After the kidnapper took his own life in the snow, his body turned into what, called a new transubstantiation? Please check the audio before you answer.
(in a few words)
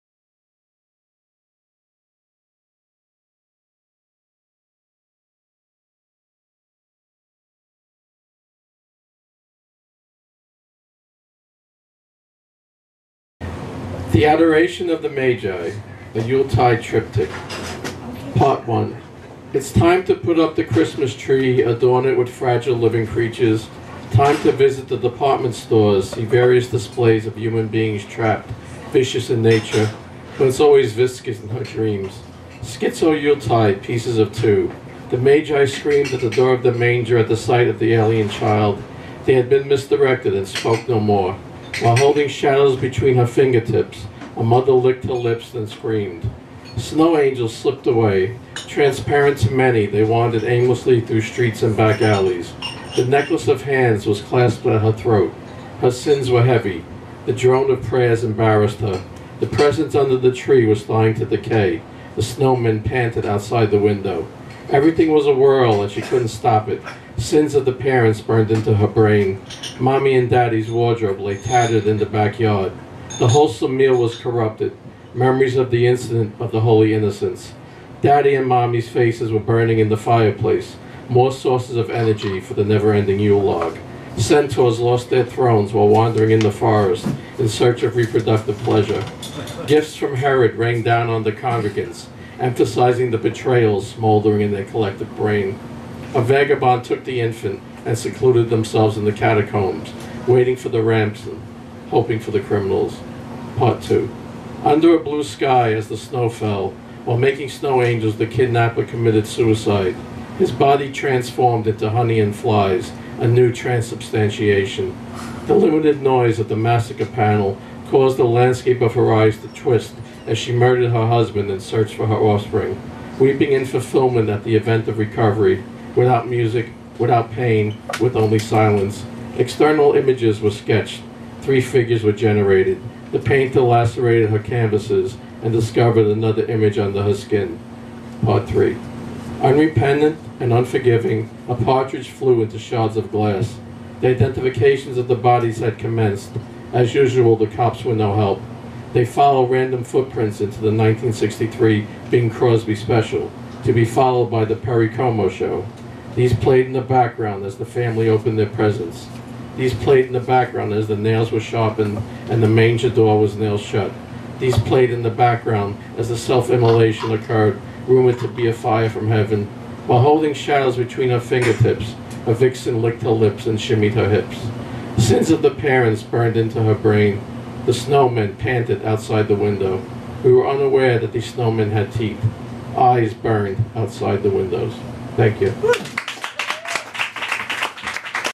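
honey and flies.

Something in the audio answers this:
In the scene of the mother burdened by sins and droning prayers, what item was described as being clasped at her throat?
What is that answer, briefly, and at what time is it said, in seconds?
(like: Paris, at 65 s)
necklace of hands, at 53 s.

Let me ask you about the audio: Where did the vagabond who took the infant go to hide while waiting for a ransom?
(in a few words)
the catacombs.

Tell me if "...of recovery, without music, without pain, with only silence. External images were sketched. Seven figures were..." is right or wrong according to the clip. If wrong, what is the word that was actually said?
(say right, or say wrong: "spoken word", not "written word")
wrong: "Three", not "Seven".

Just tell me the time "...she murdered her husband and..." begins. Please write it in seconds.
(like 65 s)
120 s.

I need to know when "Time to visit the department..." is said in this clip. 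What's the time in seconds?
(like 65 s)
24 s.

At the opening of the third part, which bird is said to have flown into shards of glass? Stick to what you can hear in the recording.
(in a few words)
a partridge.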